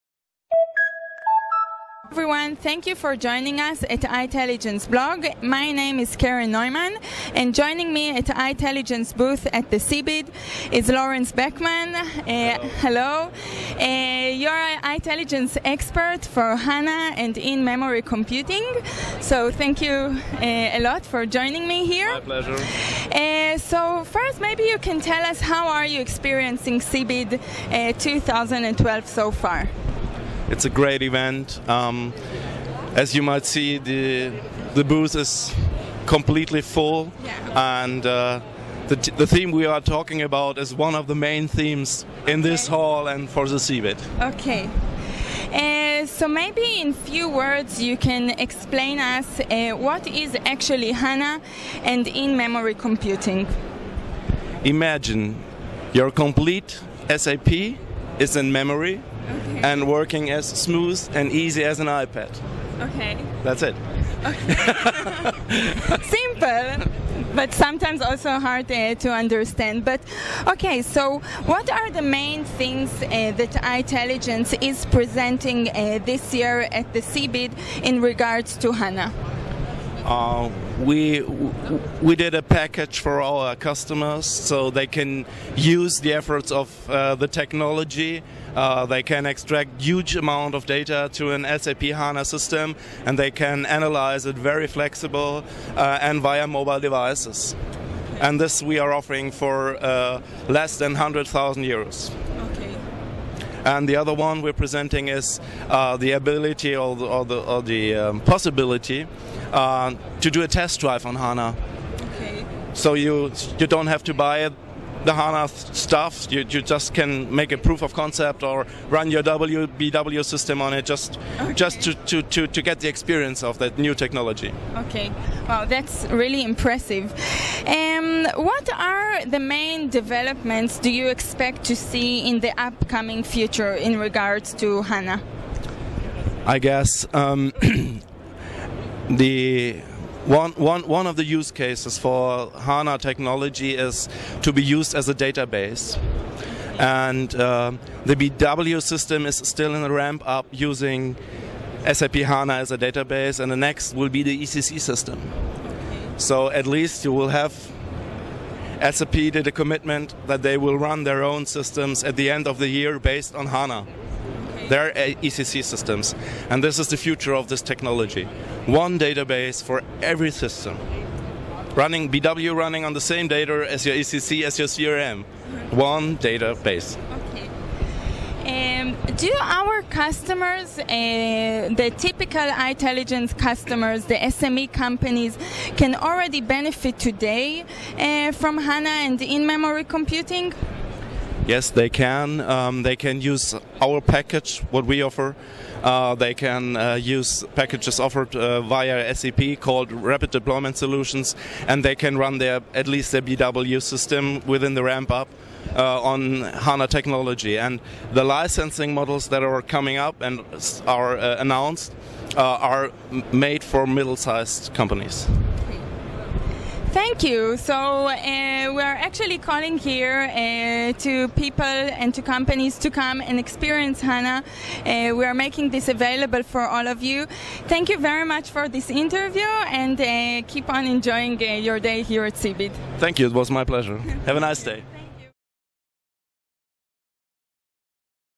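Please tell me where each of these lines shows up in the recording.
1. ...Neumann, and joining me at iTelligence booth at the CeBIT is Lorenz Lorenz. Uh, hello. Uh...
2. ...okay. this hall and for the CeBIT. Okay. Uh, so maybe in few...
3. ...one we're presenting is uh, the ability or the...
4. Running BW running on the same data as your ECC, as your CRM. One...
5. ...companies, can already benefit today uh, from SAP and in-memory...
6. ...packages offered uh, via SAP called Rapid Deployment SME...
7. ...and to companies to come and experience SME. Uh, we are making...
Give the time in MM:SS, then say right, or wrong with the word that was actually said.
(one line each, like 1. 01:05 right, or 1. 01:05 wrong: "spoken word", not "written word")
1. 00:06 wrong: "Beckman", not "Lorenz"
2. 00:42 right
3. 01:44 right
4. 02:51 right
5. 03:04 wrong: "HANA", not "SAP"
6. 03:17 wrong: "Solutions", not "SME"
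7. 03:42 wrong: "HANA", not "SME".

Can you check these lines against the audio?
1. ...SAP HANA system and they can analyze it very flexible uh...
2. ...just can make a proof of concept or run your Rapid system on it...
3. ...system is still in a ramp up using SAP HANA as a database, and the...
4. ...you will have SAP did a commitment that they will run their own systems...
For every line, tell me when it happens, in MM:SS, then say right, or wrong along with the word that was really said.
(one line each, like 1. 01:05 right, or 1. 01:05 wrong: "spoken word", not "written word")
1. 01:31 right
2. 01:56 wrong: "WBW", not "Rapid"
3. 02:28 right
4. 02:37 right.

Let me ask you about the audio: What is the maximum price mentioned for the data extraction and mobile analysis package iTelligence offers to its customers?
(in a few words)
less than 100,000 euros.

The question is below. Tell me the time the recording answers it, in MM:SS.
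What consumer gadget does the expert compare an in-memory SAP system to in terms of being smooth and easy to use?
01:01.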